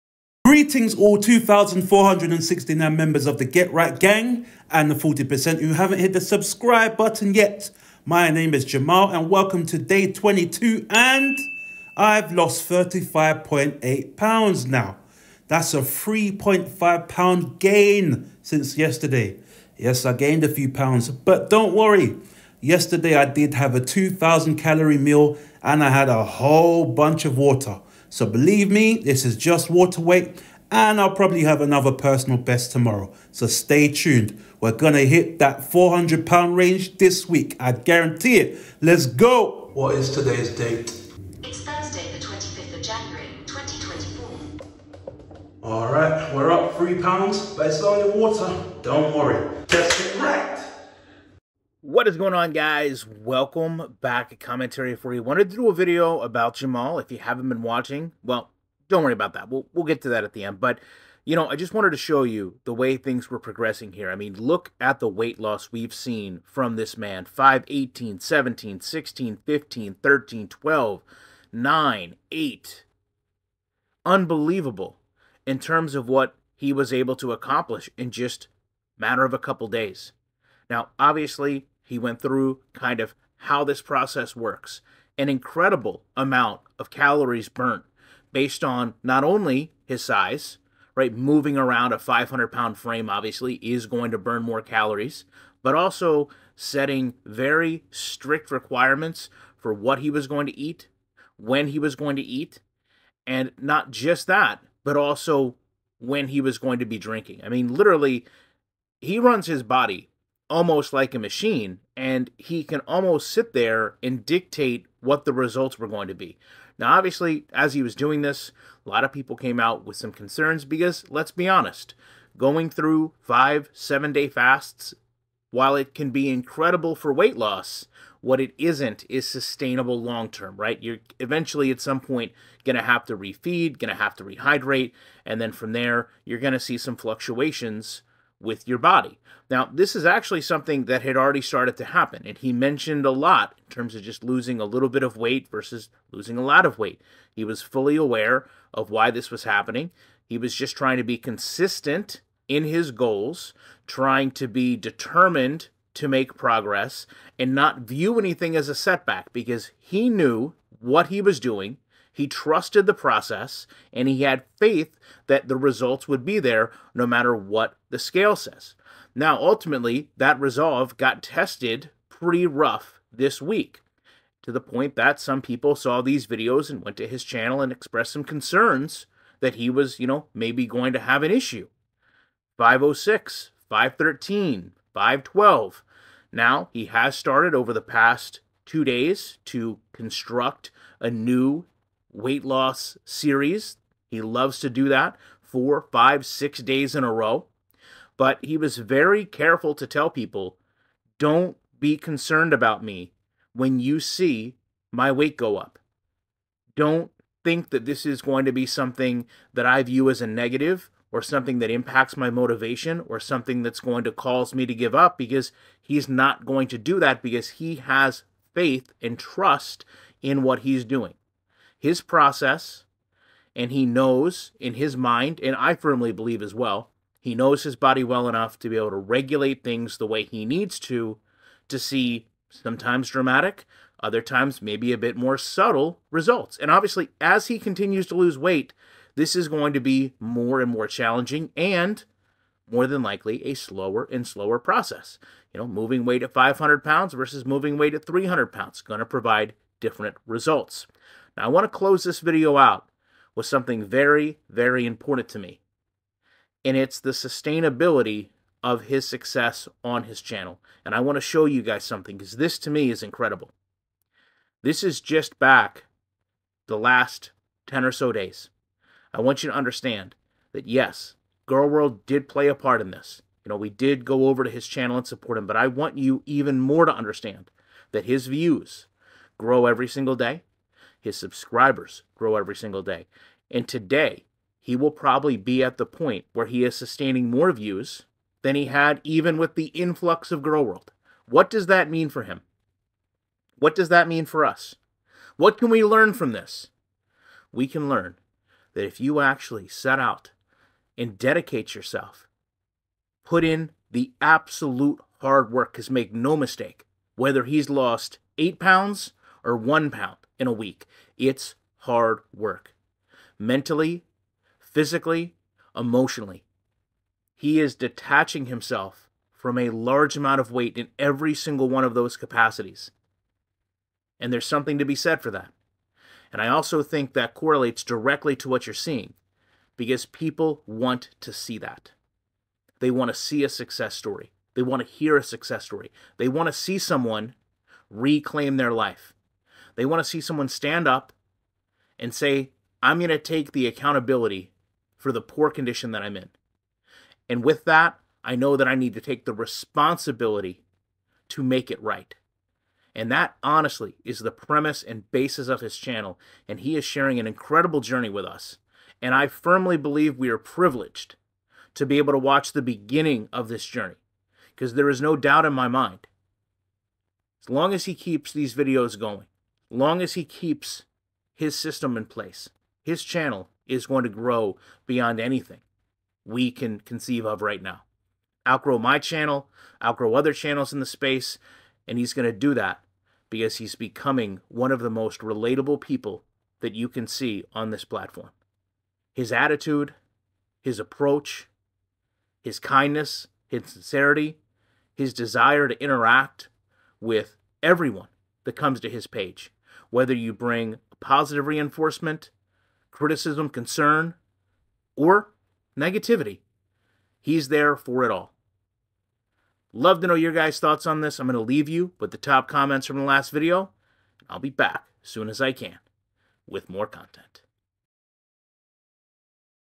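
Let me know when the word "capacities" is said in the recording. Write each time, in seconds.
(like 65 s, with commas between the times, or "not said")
322 s.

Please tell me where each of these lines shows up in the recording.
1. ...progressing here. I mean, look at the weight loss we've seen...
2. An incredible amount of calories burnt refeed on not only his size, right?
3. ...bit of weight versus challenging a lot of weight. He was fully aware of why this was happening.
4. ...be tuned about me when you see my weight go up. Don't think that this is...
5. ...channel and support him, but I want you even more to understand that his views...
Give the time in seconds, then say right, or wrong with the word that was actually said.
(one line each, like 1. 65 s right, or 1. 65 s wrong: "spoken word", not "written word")
1. 63 s right
2. 85 s wrong: "based", not "refeed"
3. 144 s wrong: "losing", not "challenging"
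4. 201 s wrong: "concerned", not "tuned"
5. 274 s right.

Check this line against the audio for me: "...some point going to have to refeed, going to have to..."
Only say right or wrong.
right.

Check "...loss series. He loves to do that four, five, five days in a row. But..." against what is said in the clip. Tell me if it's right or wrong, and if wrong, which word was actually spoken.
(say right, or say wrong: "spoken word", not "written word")
wrong: "six", not "five".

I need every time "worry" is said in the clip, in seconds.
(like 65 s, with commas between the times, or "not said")
21 s, 49 s, 59 s.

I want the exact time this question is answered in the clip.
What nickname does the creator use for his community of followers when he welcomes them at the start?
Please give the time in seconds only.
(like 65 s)
3 s.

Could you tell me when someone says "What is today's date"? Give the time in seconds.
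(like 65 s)
39 s.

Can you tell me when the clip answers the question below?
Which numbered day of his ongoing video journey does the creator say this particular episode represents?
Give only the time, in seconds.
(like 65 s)
9 s.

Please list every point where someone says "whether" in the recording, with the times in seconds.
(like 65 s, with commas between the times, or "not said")
307 s, 399 s.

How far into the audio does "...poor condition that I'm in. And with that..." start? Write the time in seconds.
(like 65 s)
345 s.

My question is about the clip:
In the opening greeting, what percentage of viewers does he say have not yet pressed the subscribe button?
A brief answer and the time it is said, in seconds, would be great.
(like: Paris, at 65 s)
40%, at 4 s.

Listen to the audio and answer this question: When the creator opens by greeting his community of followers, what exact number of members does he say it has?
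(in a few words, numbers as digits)
2,469.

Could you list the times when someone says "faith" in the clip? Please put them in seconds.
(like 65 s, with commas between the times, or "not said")
164 s, 218 s.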